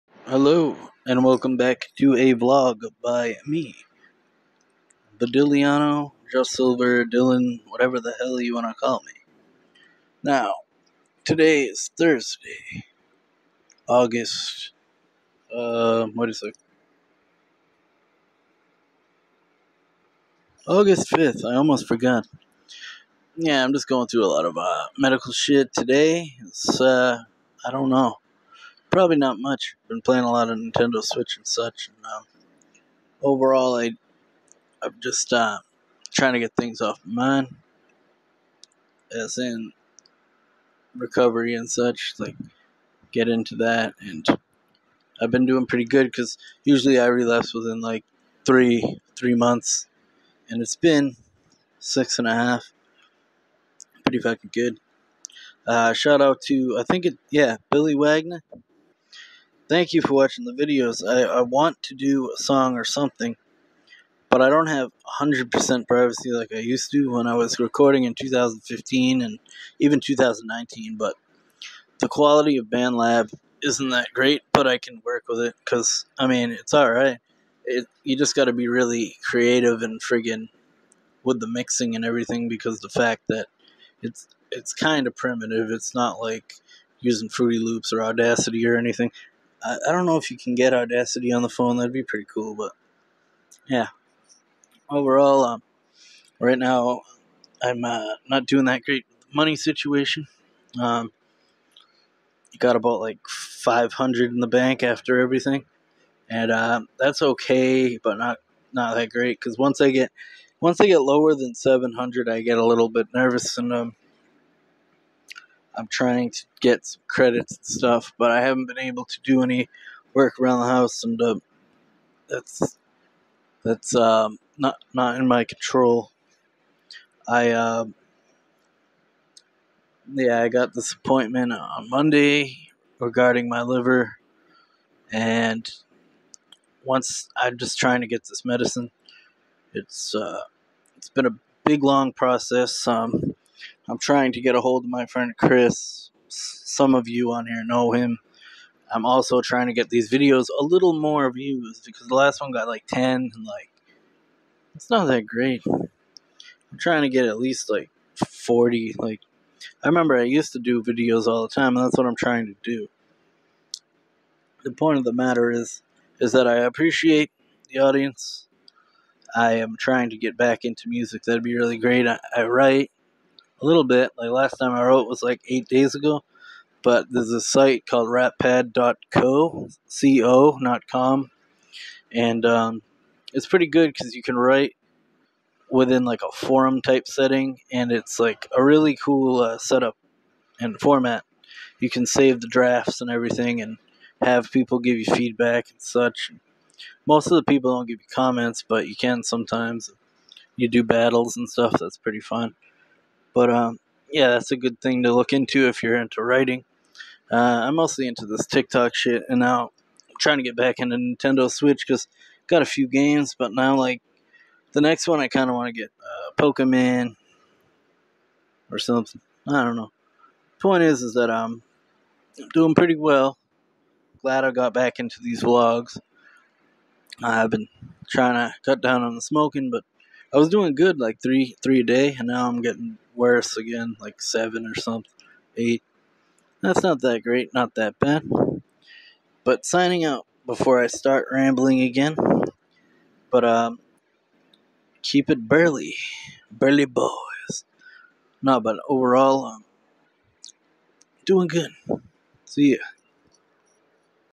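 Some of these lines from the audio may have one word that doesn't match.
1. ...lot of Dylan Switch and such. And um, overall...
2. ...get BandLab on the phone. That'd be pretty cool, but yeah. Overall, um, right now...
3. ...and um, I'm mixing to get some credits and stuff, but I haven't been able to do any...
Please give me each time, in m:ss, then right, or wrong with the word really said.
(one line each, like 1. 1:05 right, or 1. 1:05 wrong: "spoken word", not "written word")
1. 0:30 wrong: "Nintendo", not "Dylan"
2. 1:30 wrong: "Audacity", not "BandLab"
3. 1:53 wrong: "trying", not "mixing".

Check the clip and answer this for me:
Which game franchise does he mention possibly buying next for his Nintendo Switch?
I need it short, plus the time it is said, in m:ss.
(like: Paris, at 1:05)
Pokemon, at 3:36.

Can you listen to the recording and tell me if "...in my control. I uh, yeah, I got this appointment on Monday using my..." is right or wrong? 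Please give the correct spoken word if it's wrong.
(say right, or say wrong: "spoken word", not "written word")
wrong: "regarding", not "using".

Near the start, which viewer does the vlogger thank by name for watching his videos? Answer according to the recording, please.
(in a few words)
Billy Wagner.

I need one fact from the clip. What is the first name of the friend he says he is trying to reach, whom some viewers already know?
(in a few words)
Chris.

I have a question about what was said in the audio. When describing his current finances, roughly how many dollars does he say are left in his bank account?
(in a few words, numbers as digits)
500.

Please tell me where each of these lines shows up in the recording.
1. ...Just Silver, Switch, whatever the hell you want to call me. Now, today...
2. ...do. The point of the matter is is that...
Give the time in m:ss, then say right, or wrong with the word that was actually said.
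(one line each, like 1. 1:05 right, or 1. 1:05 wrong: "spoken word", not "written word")
1. 0:06 wrong: "Dylan", not "Switch"
2. 2:42 right.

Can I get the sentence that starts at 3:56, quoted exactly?
That's not that great, not that bad.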